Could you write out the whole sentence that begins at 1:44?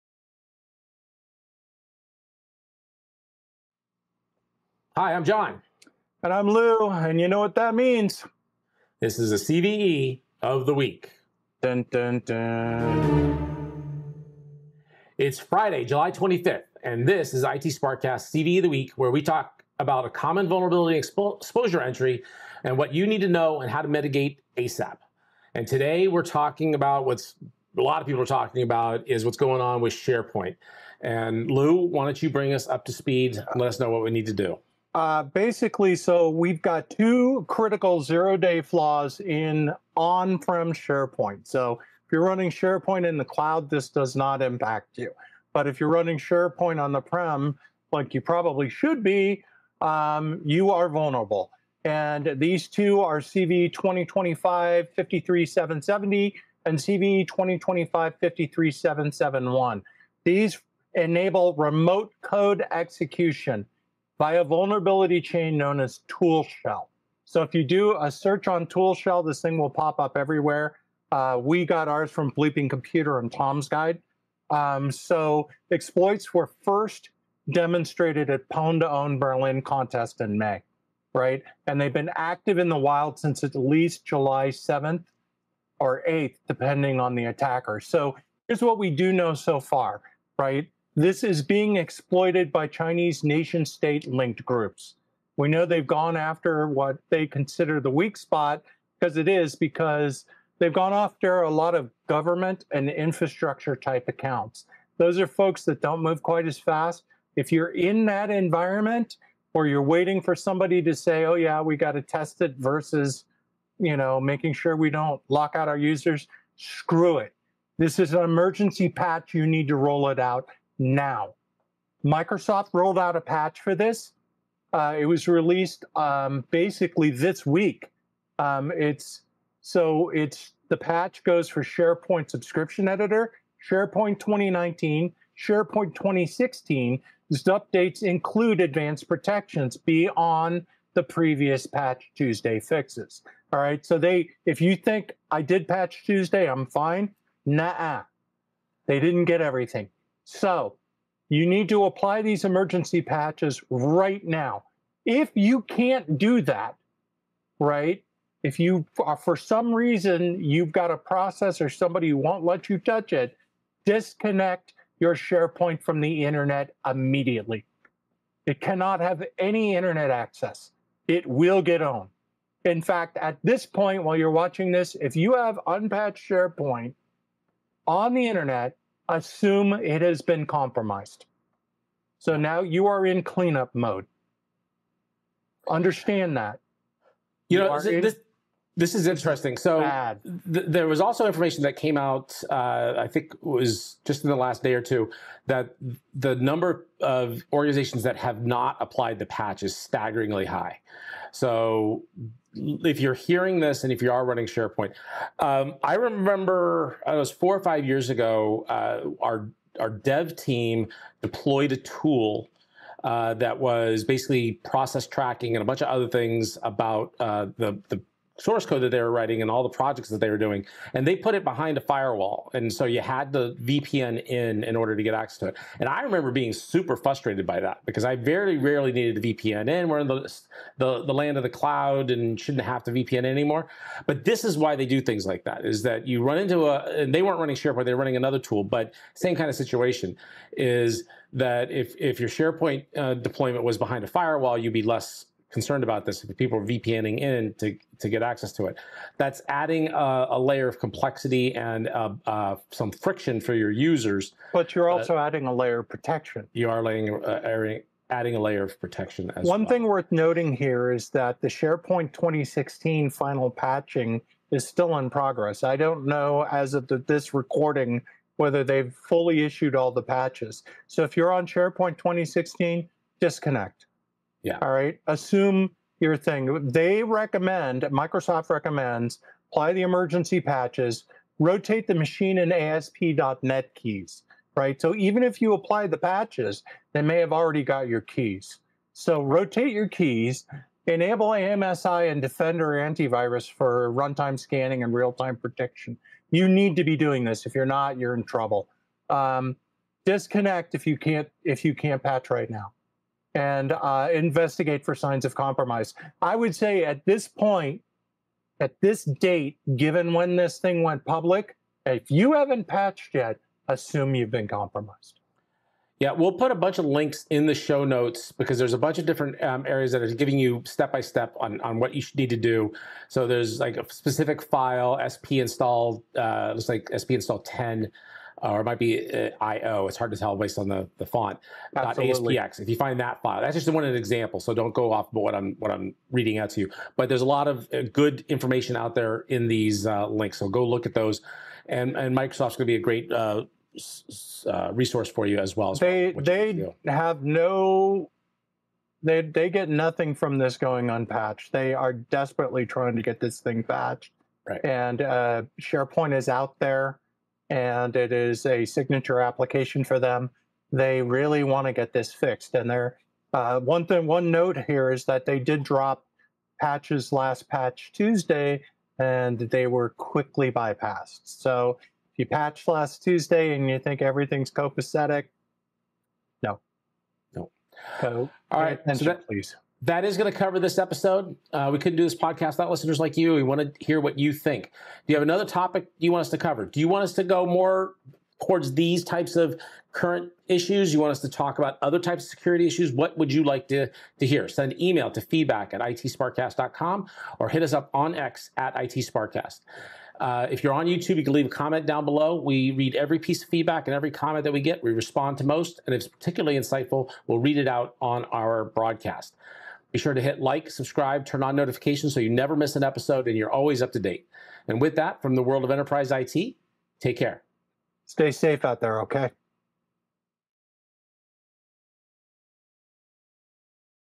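Those are folks that don't move quite as fast.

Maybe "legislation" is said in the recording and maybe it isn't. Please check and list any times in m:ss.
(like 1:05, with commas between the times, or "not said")
not said.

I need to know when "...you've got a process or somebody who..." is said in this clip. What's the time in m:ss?
2:40.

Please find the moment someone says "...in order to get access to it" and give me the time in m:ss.
3:44.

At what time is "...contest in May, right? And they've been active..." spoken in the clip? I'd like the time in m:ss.
1:19.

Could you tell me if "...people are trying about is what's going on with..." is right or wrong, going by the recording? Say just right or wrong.
wrong.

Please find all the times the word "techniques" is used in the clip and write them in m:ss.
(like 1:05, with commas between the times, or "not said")
not said.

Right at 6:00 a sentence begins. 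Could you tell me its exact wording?
They really want to get this fixed.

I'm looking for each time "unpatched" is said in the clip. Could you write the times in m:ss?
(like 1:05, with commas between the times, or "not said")
2:55, 5:50.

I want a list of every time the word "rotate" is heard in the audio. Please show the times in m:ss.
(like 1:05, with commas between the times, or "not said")
4:41, 4:49.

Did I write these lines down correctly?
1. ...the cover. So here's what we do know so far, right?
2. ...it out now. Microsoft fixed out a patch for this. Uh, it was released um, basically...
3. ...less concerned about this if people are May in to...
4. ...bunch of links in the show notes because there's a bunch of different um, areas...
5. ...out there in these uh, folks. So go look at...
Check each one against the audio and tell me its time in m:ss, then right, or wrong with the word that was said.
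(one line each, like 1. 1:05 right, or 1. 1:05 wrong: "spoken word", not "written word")
1. 1:27 wrong: "attacker", not "cover"
2. 2:00 wrong: "rolled", not "fixed"
3. 4:04 wrong: "VPNing", not "May"
4. 5:16 right
5. 5:38 wrong: "links", not "folks".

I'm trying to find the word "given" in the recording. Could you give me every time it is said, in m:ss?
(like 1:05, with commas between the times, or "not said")
5:09.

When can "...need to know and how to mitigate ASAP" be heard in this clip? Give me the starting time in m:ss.
0:23.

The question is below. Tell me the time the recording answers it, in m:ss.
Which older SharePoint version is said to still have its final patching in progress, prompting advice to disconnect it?
4:21.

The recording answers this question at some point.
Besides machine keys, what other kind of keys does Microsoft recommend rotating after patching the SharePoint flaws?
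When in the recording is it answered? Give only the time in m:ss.
4:42.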